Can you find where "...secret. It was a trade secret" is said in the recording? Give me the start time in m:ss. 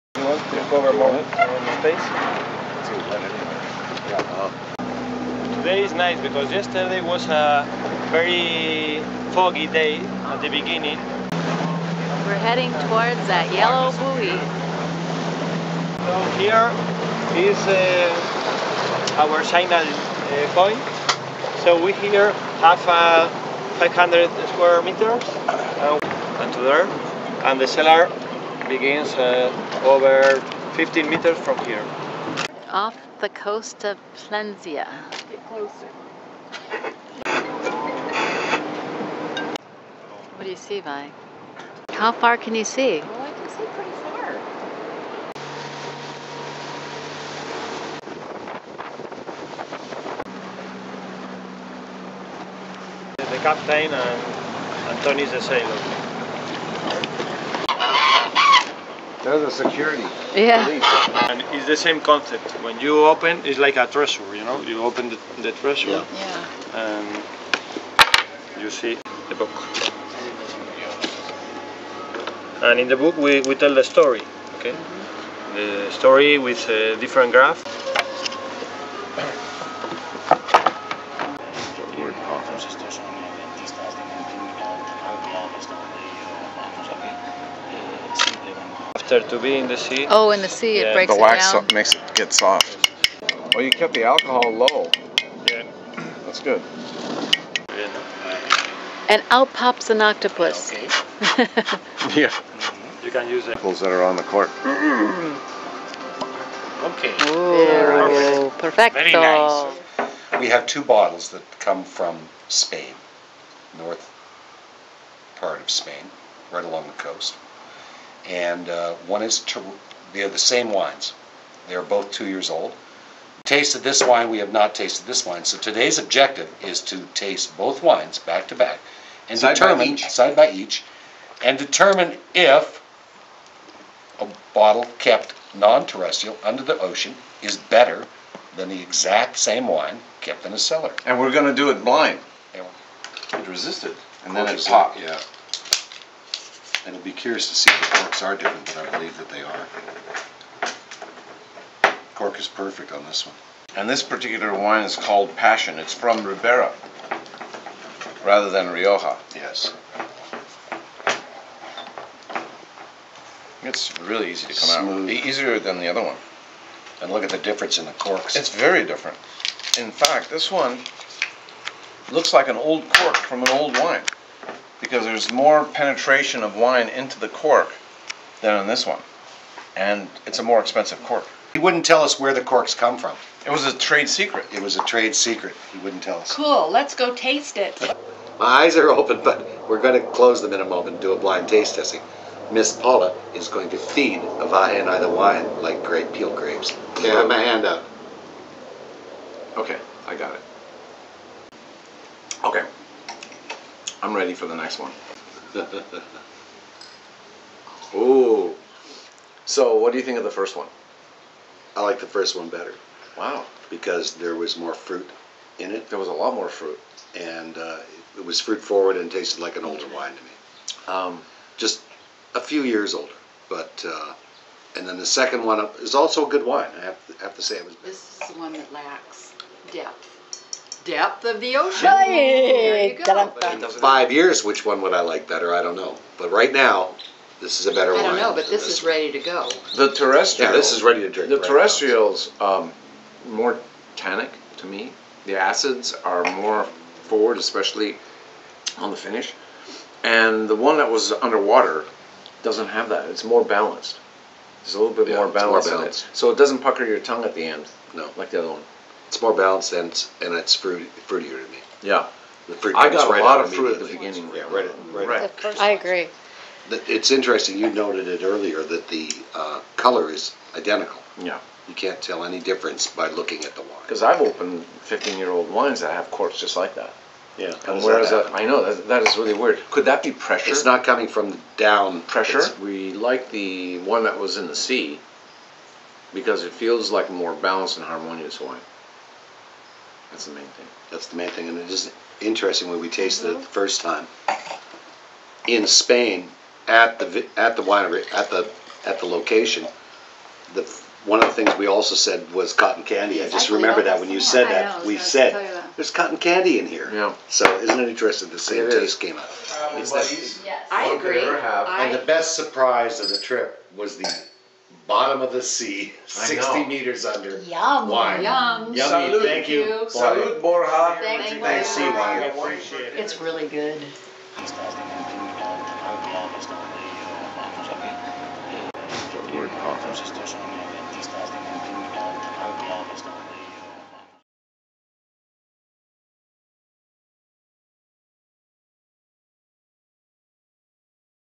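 3:04.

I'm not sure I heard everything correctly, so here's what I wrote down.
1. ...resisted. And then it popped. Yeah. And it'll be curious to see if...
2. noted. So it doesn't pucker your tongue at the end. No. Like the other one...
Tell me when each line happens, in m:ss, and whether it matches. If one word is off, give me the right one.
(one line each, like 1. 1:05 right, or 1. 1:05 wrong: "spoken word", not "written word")
1. 2:23 right
2. 4:15 wrong: "balanced", not "noted".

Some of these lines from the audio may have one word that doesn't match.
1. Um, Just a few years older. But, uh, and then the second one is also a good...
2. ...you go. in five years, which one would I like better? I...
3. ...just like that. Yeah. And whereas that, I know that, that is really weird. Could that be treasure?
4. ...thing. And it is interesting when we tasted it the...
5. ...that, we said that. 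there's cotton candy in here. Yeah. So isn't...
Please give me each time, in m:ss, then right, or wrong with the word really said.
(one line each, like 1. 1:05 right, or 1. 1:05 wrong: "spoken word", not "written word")
1. 3:40 right
2. 3:52 right
3. 4:36 wrong: "pressure", not "treasure"
4. 4:51 right
5. 5:04 right.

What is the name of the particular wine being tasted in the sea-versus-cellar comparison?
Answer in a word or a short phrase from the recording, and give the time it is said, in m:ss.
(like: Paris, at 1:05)
Passion, at 2:35.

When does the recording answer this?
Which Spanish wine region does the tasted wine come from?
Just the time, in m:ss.
2:36.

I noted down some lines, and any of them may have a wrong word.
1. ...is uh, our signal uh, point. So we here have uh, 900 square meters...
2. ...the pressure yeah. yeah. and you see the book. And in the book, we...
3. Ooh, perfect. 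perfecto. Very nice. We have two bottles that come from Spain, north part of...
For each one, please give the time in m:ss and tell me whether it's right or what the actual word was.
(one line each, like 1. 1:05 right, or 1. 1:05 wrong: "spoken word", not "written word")
1. 0:17 wrong: "500", not "900"
2. 1:05 wrong: "treasure", not "pressure"
3. 1:47 right.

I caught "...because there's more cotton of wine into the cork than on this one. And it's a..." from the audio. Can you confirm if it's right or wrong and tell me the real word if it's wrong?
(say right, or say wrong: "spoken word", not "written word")
wrong: "penetration", not "cotton".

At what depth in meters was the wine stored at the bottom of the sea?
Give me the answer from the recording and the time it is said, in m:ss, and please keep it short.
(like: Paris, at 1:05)
60 meters, at 5:16.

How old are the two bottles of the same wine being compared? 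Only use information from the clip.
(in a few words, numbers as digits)
2 years.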